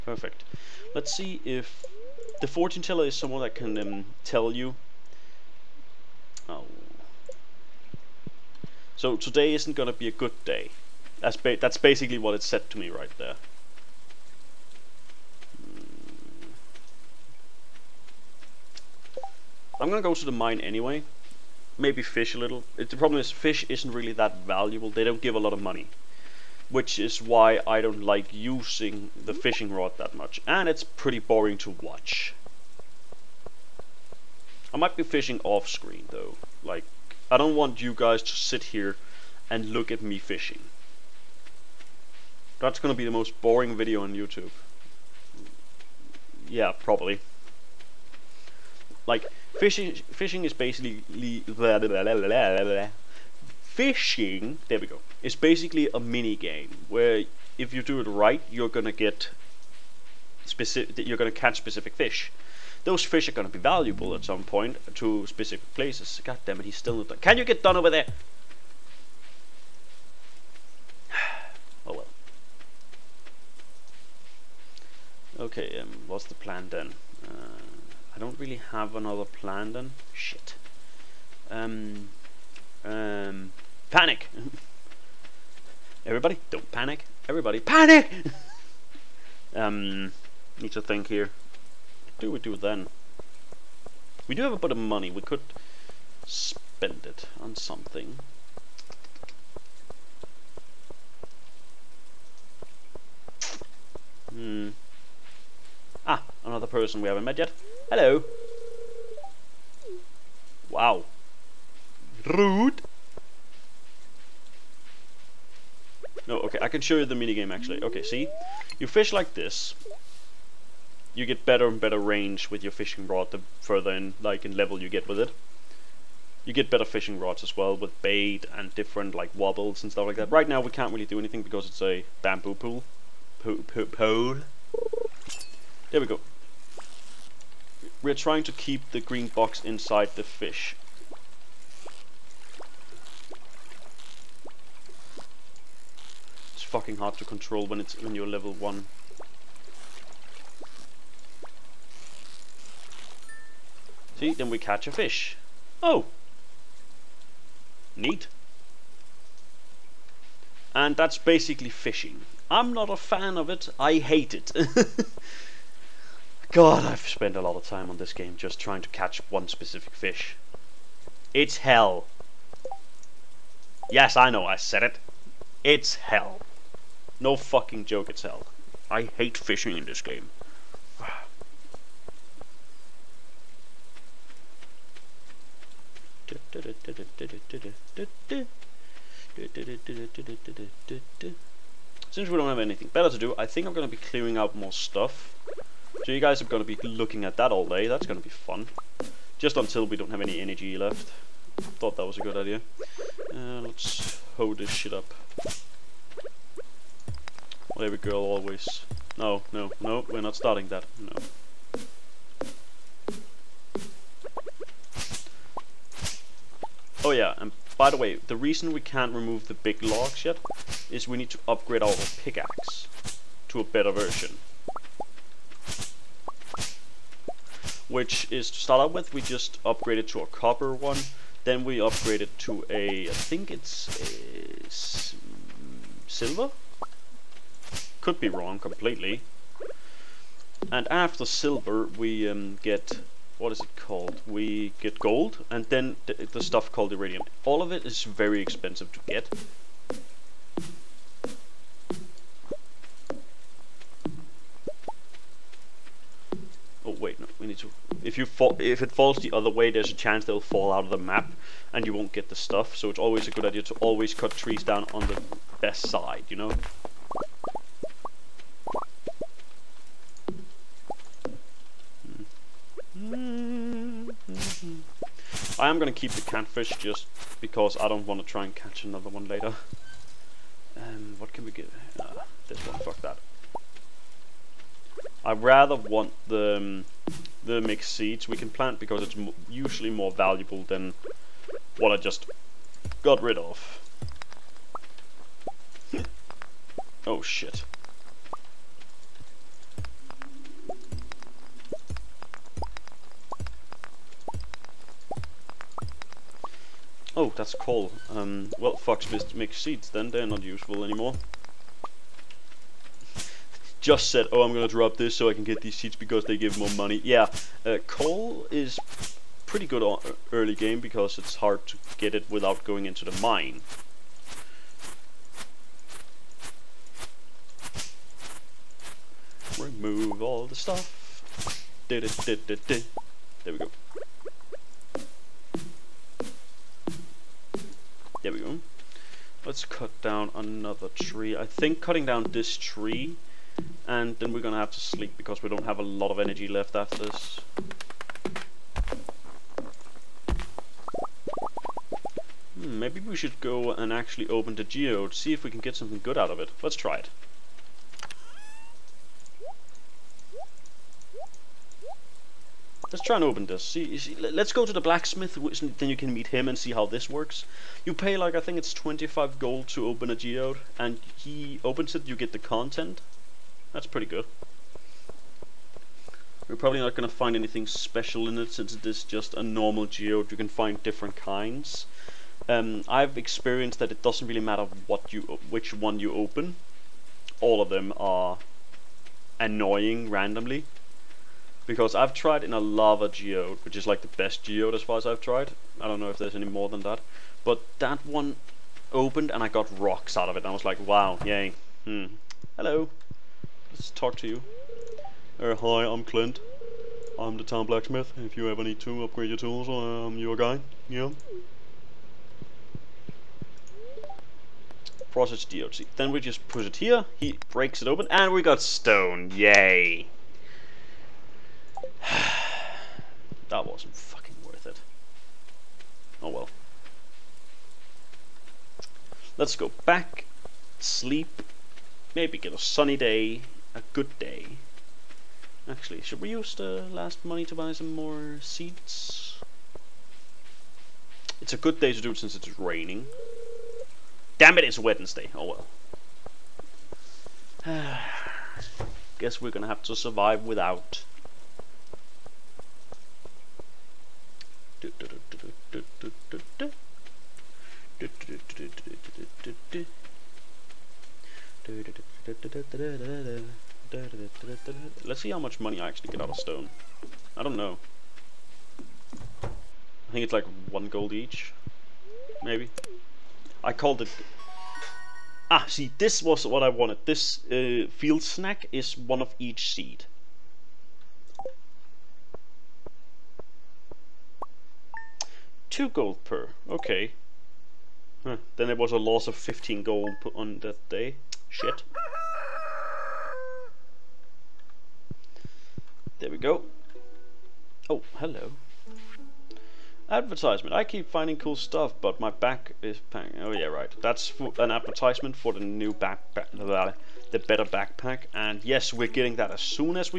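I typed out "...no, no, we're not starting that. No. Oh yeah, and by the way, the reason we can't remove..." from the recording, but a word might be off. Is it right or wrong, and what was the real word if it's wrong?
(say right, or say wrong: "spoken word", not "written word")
right.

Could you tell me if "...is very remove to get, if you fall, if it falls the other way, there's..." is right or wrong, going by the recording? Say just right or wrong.
wrong.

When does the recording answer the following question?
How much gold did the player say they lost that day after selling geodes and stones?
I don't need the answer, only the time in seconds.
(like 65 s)
489 s.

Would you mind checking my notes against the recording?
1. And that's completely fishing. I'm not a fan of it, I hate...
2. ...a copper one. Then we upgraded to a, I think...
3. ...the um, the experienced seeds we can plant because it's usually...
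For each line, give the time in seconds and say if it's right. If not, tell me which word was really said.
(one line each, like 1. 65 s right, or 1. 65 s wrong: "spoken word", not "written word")
1. 160 s wrong: "basically", not "completely"
2. 230 s right
3. 286 s wrong: "mixed", not "experienced".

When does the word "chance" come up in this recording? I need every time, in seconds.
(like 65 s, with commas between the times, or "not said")
259 s.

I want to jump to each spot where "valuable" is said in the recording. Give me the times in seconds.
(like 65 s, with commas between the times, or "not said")
24 s, 63 s, 290 s.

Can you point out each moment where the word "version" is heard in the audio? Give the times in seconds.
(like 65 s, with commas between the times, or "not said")
223 s.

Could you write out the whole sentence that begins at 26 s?
Which is why I don't like using the fishing rod that much.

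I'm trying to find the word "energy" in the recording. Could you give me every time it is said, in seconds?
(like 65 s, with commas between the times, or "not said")
200 s, 346 s.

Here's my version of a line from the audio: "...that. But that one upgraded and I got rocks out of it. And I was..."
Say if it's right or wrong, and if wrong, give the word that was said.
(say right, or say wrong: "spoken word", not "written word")
wrong: "opened", not "upgraded".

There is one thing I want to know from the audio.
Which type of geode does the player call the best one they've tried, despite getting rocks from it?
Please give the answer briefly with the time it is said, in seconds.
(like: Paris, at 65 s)
Lava geode, at 392 s.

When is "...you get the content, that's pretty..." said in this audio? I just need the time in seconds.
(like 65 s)
372 s.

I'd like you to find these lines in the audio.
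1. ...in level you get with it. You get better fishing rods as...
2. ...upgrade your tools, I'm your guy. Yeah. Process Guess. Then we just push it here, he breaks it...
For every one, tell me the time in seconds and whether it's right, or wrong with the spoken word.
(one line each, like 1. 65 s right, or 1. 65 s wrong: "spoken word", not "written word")
1. 124 s right
2. 409 s wrong: "DLC", not "Guess".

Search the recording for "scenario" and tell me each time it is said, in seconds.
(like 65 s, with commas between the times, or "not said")
not said.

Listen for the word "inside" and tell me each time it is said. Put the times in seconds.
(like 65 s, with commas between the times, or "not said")
139 s.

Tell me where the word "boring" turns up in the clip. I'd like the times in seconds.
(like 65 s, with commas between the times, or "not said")
31 s, 43 s.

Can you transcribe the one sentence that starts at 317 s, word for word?
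Yeah, uh, coal is pretty good on early game because it's hard to get it without going into the mine.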